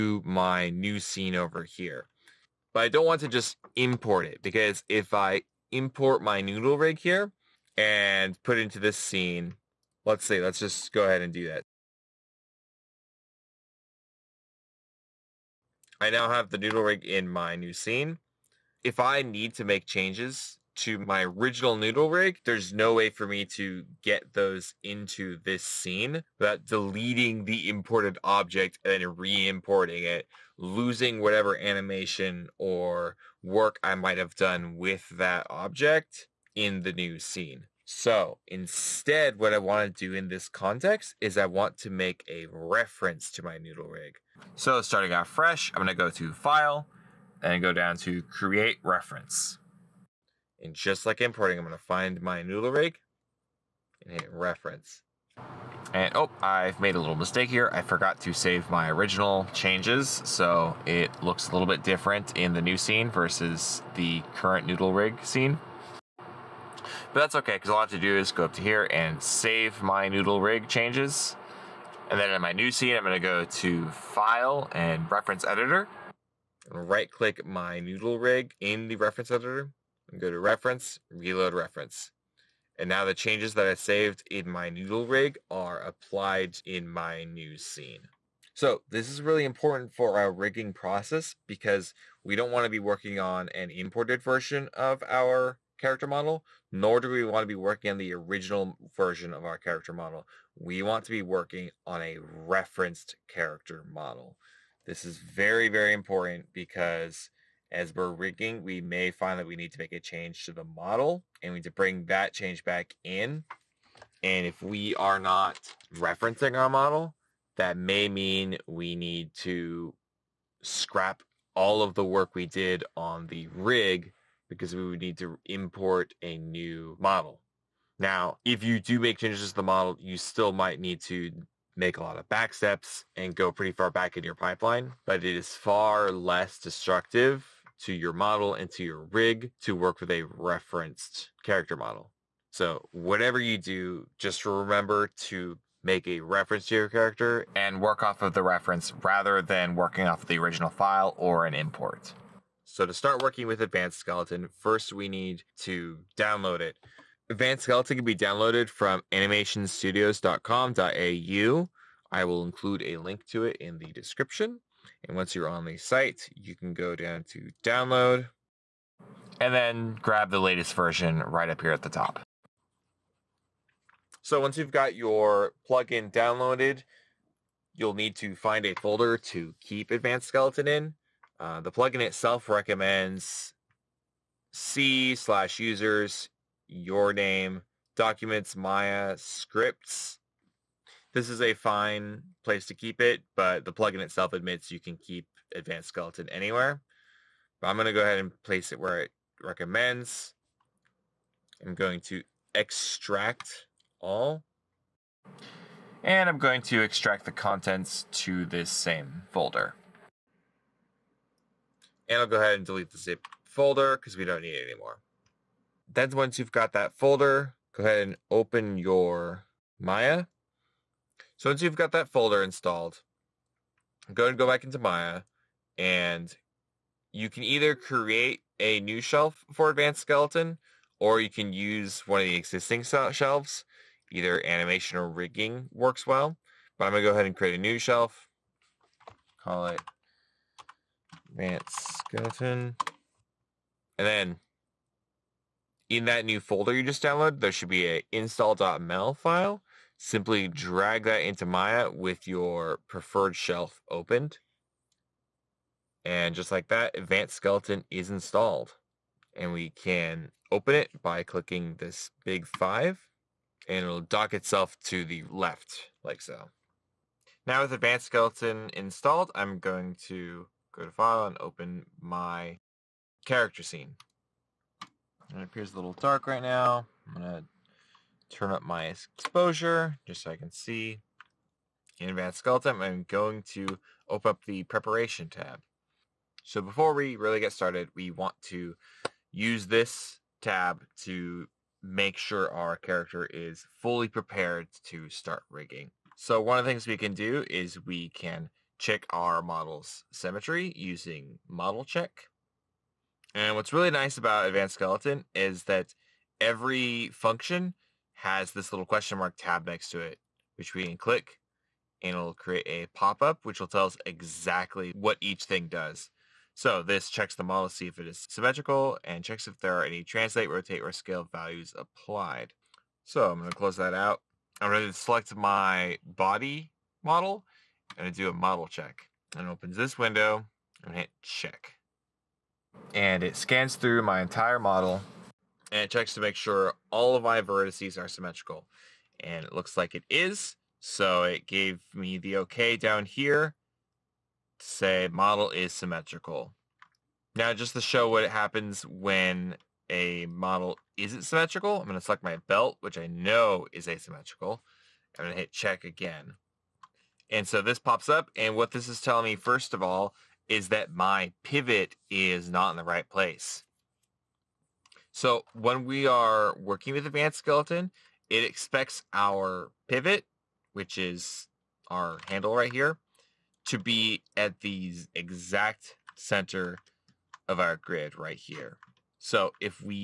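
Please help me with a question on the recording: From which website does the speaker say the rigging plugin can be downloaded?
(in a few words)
animationstudios.com.au.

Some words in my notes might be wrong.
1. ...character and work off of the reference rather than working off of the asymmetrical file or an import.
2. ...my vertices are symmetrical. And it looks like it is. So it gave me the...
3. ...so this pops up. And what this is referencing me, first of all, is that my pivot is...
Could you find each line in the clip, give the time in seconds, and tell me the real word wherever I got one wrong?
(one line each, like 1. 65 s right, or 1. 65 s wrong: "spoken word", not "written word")
1. 146 s wrong: "original", not "asymmetrical"
2. 337 s right
3. 357 s wrong: "telling", not "referencing".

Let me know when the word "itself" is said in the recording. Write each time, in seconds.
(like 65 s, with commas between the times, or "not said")
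182 s, 194 s, 264 s.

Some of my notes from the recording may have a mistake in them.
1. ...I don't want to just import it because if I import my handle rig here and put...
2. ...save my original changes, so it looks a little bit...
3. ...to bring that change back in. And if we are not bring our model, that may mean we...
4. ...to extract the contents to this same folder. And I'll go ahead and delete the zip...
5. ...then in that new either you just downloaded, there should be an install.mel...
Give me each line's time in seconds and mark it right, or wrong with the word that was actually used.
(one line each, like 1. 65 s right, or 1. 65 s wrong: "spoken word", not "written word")
1. 2 s wrong: "noodle", not "handle"
2. 58 s right
3. 111 s wrong: "referencing", not "bring"
4. 206 s right
5. 244 s wrong: "folder", not "either".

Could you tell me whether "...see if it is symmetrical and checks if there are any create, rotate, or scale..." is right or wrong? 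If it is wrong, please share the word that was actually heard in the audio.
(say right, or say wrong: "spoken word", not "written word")
wrong: "translate", not "create".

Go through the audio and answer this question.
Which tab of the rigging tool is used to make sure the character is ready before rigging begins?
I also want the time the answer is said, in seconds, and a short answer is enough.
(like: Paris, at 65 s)
preparation tab, at 284 s.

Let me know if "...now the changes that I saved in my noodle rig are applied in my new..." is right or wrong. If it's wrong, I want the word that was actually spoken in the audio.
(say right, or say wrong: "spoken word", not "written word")
right.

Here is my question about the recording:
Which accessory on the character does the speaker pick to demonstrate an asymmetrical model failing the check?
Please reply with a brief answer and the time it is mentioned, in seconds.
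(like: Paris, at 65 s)
belt, at 352 s.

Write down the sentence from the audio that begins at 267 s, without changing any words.
Now with Advanced Skeleton installed, I'm going to go to file and open my character scene.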